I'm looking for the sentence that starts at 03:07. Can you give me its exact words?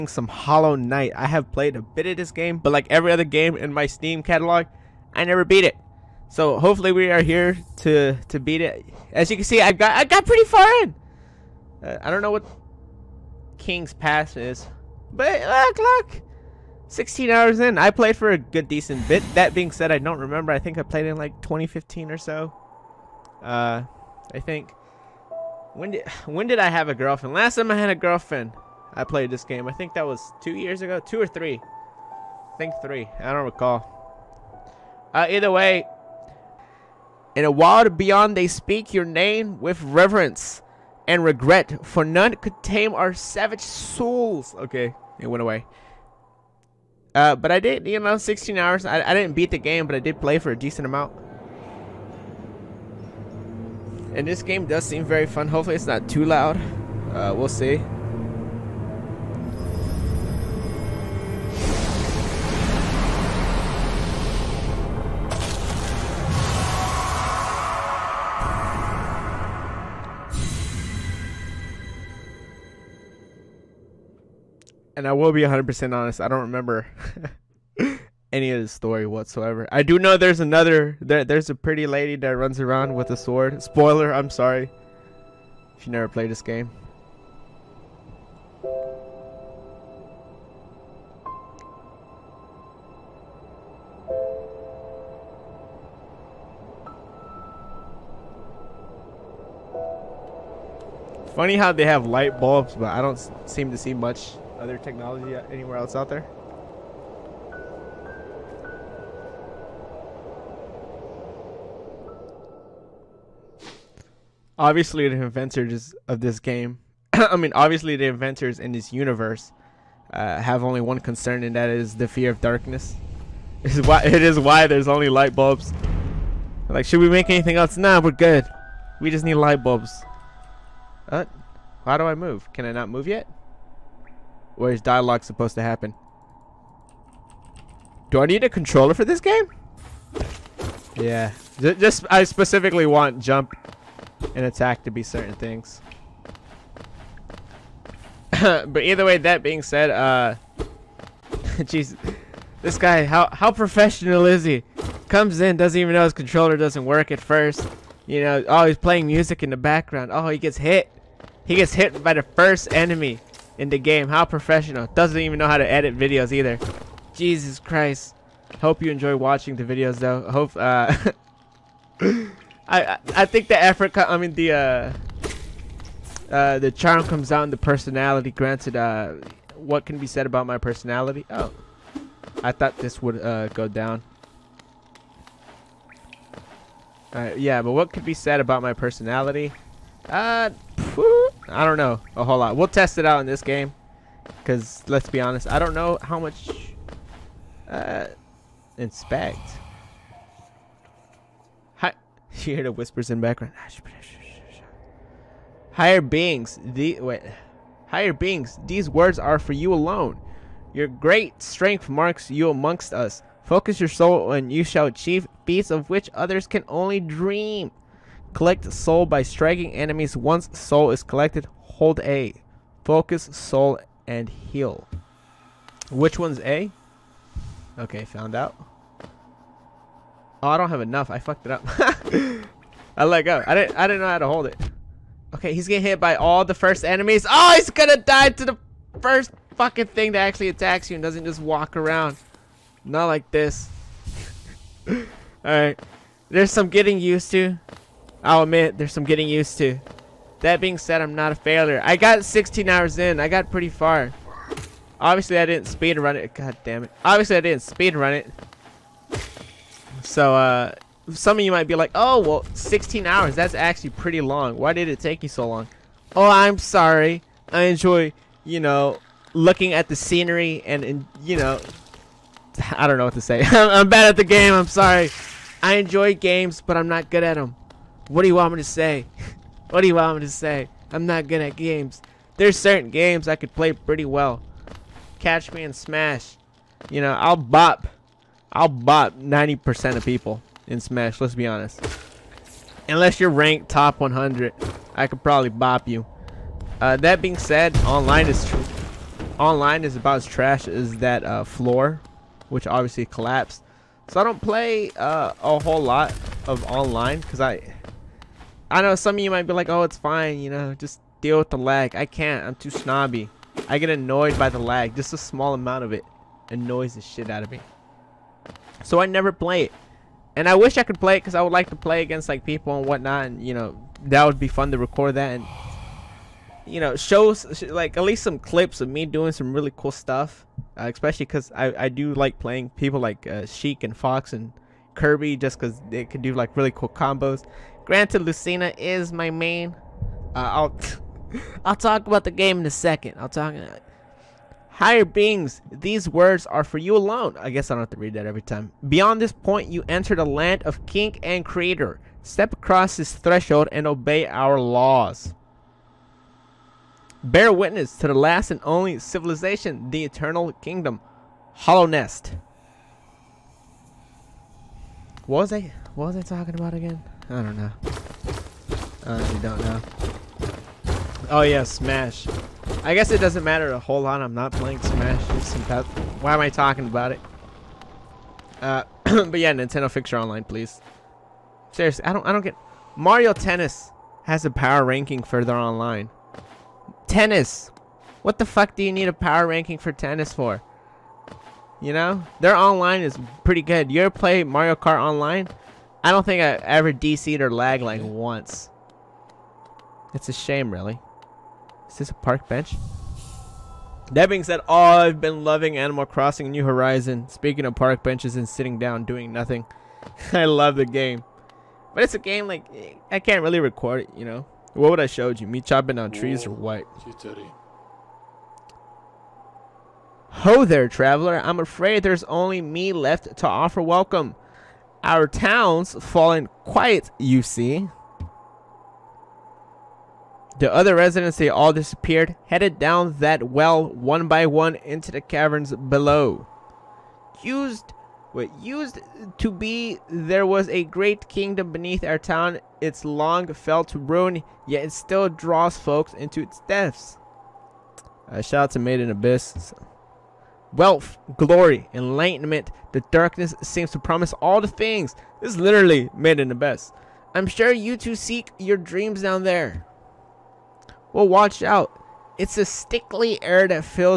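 Uh, yeah, but what could be said about my personality?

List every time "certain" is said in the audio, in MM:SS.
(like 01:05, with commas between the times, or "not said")
02:25, 04:42.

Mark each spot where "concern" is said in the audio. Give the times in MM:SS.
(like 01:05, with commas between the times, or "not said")
02:00.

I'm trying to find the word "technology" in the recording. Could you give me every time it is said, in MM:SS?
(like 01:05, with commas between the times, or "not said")
01:44.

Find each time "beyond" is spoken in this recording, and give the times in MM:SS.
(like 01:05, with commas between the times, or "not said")
00:37, 05:48.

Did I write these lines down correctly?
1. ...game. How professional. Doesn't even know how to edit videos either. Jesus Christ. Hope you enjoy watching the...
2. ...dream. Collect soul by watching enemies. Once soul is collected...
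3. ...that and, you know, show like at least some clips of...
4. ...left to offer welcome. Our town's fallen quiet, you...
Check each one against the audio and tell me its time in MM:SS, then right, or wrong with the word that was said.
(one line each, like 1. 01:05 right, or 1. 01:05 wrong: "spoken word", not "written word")
1. 02:43 right
2. 03:36 wrong: "striking", not "watching"
3. 05:25 right
4. 07:02 right.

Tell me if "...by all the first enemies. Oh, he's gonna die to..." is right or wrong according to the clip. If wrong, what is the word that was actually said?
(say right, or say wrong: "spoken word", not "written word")
right.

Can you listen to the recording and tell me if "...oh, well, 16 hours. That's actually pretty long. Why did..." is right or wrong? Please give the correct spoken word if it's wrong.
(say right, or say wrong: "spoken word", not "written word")
right.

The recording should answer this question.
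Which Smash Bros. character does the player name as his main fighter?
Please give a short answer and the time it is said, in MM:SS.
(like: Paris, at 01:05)
Lucina, at 05:38.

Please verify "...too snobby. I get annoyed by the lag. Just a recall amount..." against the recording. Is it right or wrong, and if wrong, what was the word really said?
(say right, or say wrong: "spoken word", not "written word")
wrong: "small", not "recall".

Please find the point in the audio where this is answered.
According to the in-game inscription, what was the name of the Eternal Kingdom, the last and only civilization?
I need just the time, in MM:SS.
06:01.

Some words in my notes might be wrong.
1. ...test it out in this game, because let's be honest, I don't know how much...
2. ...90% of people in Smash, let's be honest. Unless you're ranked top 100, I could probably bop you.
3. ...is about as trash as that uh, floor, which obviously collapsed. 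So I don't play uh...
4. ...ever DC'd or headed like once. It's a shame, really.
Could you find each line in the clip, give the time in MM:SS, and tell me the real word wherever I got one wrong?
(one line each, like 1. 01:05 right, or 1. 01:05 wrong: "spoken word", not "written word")
1. 03:12 right
2. 04:49 right
3. 04:59 right
4. 06:36 wrong: "lagged", not "headed".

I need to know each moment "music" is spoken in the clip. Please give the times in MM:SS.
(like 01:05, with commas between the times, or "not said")
02:39.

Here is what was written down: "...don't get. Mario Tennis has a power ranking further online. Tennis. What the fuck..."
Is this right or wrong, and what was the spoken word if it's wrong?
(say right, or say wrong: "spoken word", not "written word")
right.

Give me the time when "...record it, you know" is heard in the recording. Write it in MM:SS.
06:53.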